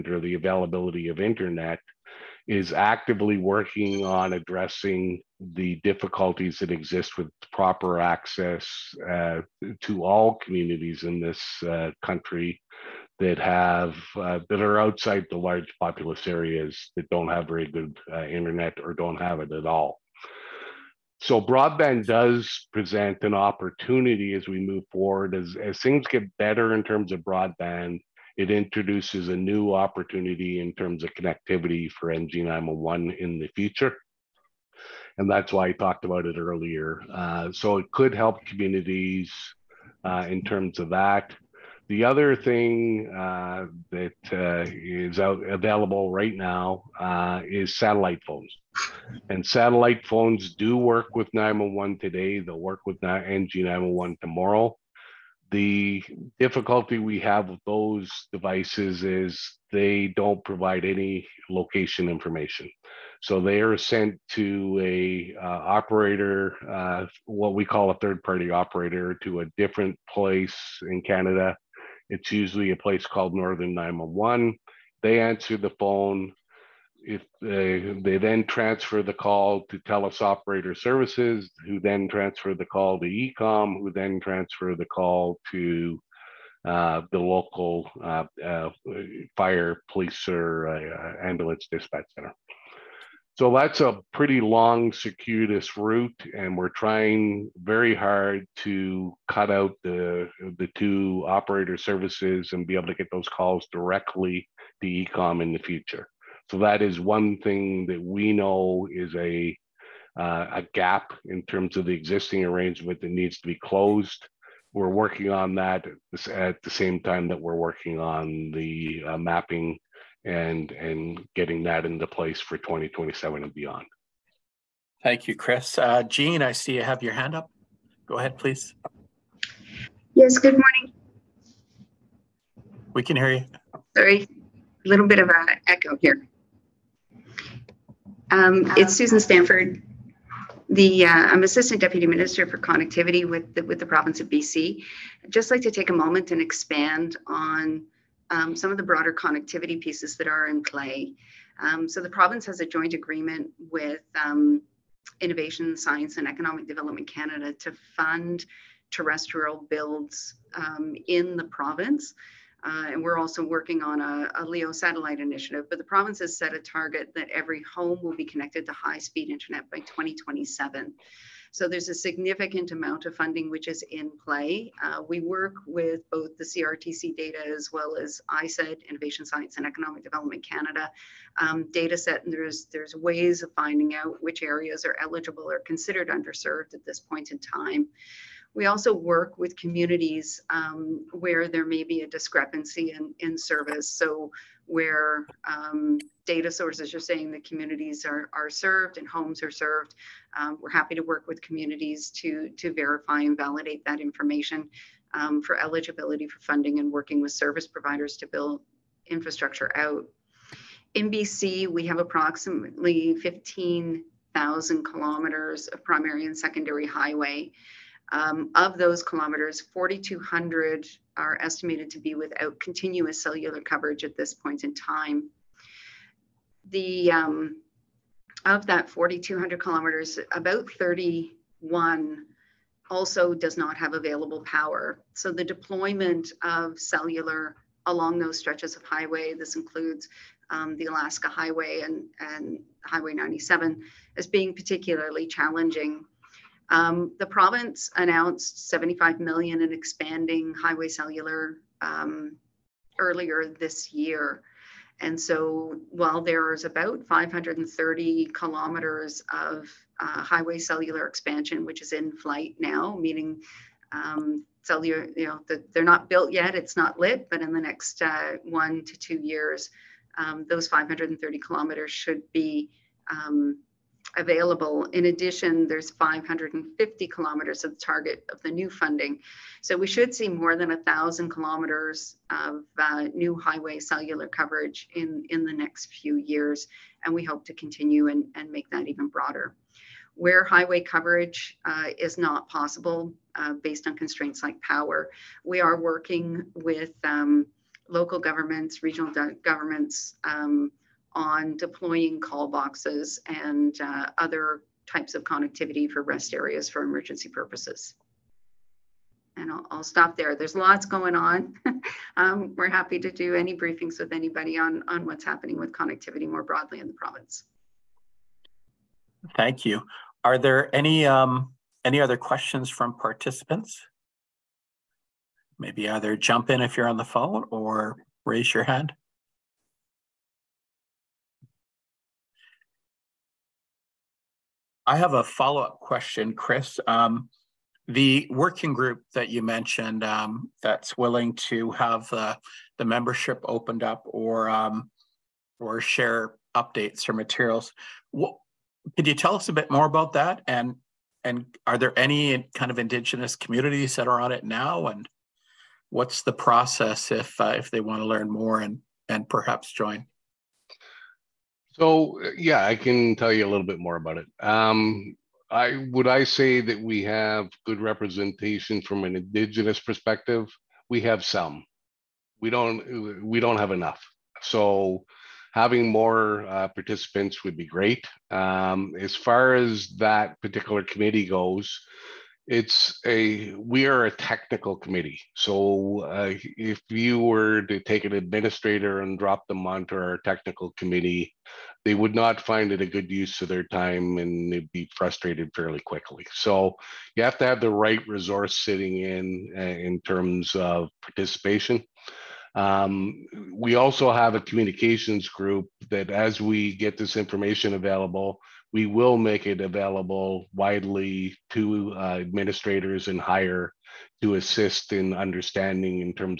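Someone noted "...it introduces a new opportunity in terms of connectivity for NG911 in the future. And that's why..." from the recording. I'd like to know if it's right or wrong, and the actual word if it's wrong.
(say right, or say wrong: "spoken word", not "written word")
right.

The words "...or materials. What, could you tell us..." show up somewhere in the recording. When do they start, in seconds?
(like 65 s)
347 s.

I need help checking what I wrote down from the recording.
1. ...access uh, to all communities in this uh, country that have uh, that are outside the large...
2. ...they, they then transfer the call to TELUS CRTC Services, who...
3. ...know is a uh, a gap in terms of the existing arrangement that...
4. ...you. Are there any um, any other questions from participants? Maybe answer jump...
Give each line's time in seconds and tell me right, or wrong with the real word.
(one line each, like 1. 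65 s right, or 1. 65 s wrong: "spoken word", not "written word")
1. 7 s right
2. 77 s wrong: "Operator", not "CRTC"
3. 108 s right
4. 319 s wrong: "either", not "answer".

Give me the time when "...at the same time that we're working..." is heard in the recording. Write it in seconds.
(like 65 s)
116 s.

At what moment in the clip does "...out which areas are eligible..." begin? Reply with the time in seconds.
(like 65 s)
183 s.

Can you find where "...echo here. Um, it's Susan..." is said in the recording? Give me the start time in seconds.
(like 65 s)
135 s.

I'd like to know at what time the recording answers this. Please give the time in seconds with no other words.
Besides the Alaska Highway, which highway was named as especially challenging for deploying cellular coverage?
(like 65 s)
242 s.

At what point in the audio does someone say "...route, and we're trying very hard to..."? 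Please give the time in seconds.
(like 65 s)
95 s.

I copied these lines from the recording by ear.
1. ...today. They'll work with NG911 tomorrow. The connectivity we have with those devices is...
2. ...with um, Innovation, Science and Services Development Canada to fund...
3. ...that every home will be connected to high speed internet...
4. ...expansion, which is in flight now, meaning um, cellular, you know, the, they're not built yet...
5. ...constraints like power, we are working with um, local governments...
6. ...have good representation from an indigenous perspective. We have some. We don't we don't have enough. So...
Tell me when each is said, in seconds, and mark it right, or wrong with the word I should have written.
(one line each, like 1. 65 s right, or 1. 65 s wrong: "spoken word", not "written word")
1. 51 s wrong: "difficulty", not "connectivity"
2. 153 s wrong: "Economic", not "Services"
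3. 167 s right
4. 261 s right
5. 293 s right
6. 367 s right.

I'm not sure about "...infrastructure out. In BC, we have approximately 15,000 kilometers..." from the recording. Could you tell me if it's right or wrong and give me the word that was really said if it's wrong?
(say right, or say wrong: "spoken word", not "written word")
right.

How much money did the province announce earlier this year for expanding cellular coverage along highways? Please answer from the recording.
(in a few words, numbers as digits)
75 million.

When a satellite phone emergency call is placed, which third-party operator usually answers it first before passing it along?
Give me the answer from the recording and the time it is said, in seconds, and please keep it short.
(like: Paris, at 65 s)
Northern 911, at 73 s.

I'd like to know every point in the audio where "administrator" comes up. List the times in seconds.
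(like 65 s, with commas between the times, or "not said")
388 s, 412 s.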